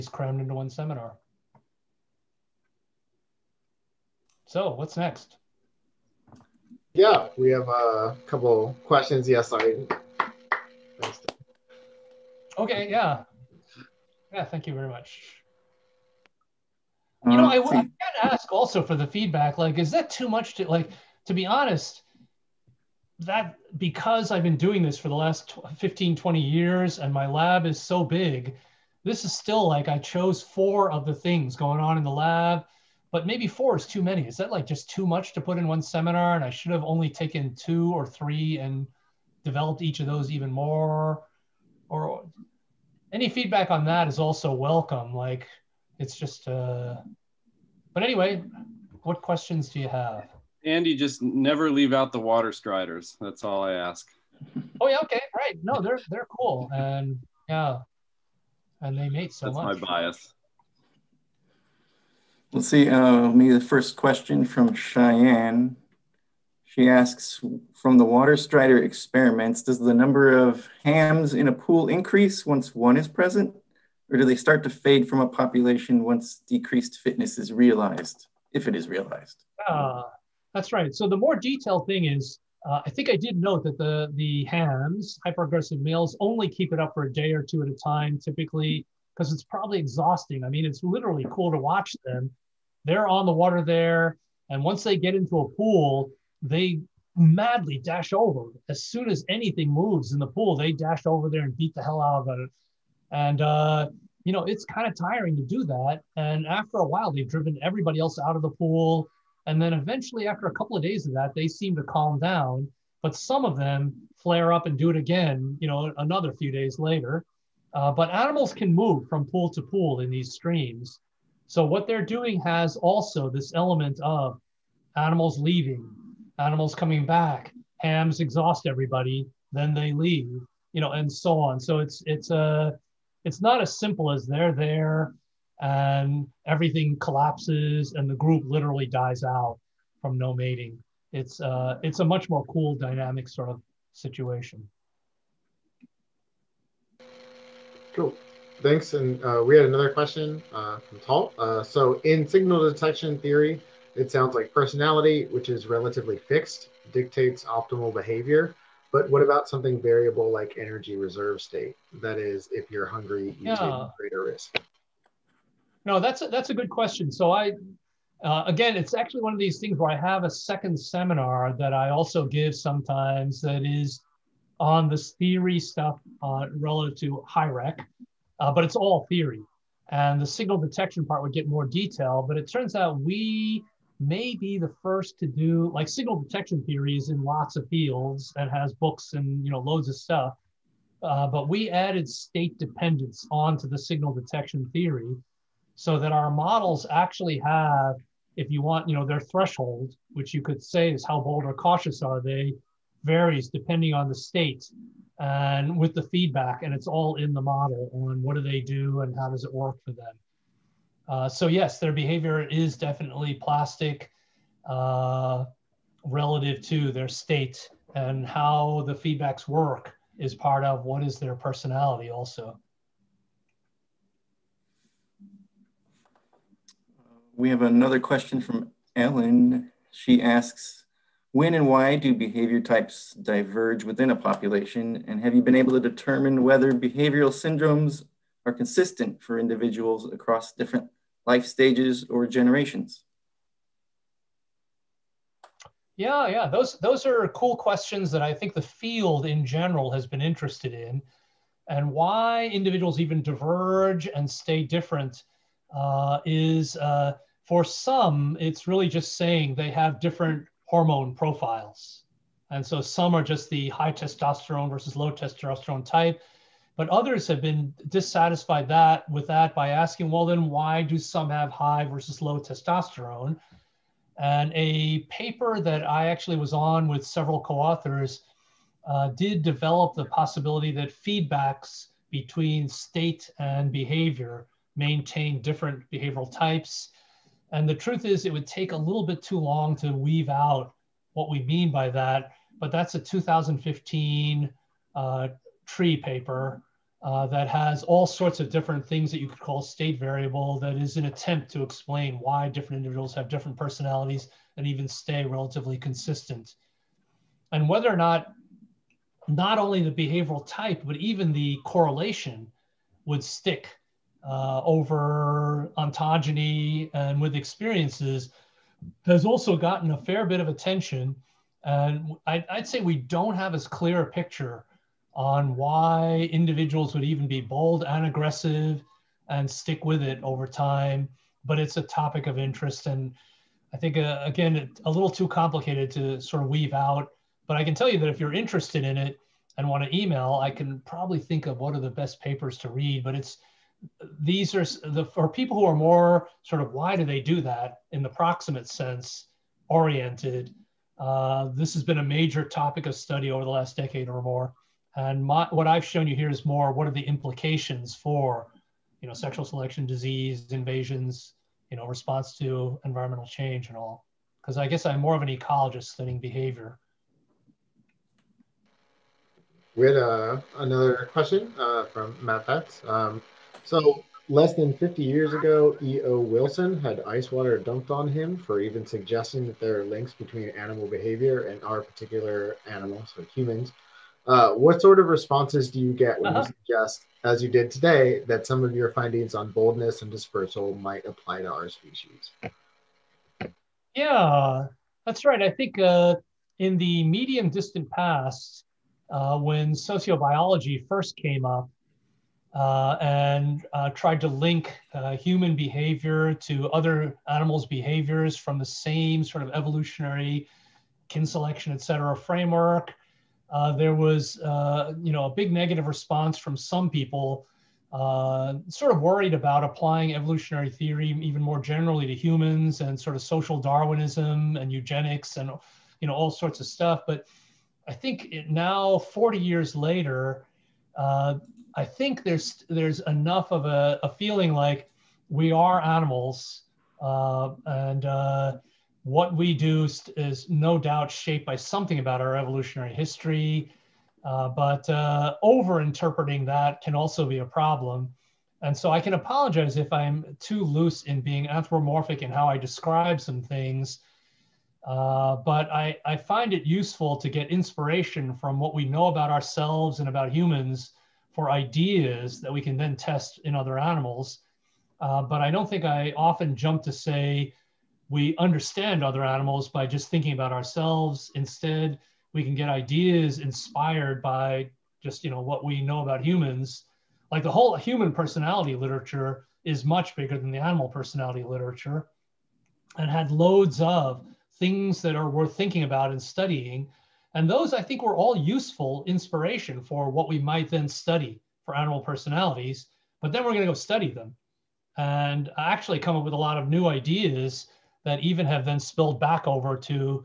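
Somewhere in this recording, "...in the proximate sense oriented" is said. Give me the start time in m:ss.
5:47.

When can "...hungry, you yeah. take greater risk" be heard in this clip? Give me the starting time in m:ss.
2:42.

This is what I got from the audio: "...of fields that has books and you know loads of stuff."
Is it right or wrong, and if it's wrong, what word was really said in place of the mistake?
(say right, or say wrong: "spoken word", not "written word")
right.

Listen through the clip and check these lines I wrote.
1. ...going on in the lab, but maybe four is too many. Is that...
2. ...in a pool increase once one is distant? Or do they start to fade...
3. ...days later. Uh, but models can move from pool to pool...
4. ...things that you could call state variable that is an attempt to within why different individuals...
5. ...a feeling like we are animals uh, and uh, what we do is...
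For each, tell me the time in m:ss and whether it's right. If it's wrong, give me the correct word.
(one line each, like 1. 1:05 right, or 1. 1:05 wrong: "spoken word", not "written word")
1. 0:31 right
2. 1:11 wrong: "present", not "distant"
3. 1:56 wrong: "animals", not "models"
4. 4:58 wrong: "explain", not "within"
5. 7:14 right.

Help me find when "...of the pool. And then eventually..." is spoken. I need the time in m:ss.
1:48.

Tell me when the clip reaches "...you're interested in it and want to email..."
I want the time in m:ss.
5:38.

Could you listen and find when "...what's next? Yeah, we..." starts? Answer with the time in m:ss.
0:04.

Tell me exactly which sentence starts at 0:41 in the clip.
Or any feedback on that is also welcome.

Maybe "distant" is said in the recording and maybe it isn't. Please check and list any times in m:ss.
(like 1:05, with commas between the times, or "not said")
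6:37.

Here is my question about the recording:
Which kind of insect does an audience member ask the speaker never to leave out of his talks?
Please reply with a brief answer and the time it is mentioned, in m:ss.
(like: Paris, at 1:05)
Water striders, at 0:52.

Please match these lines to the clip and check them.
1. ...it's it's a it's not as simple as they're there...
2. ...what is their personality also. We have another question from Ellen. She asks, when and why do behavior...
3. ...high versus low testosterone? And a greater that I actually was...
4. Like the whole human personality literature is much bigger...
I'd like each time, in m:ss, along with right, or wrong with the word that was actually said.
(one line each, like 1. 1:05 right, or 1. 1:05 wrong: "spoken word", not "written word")
1. 2:11 right
2. 3:40 right
3. 4:31 wrong: "paper", not "greater"
4. 7:57 right.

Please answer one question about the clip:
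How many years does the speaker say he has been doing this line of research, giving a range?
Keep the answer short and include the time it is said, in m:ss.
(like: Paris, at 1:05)
15-20 years, at 0:25.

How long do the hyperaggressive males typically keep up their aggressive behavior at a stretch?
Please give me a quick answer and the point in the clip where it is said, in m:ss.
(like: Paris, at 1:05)
A day or two, at 1:27.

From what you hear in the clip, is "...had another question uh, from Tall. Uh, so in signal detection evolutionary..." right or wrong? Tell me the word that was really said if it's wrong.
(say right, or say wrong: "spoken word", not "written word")
wrong: "theory", not "evolutionary".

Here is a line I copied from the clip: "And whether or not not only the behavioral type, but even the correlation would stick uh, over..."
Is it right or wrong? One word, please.
right.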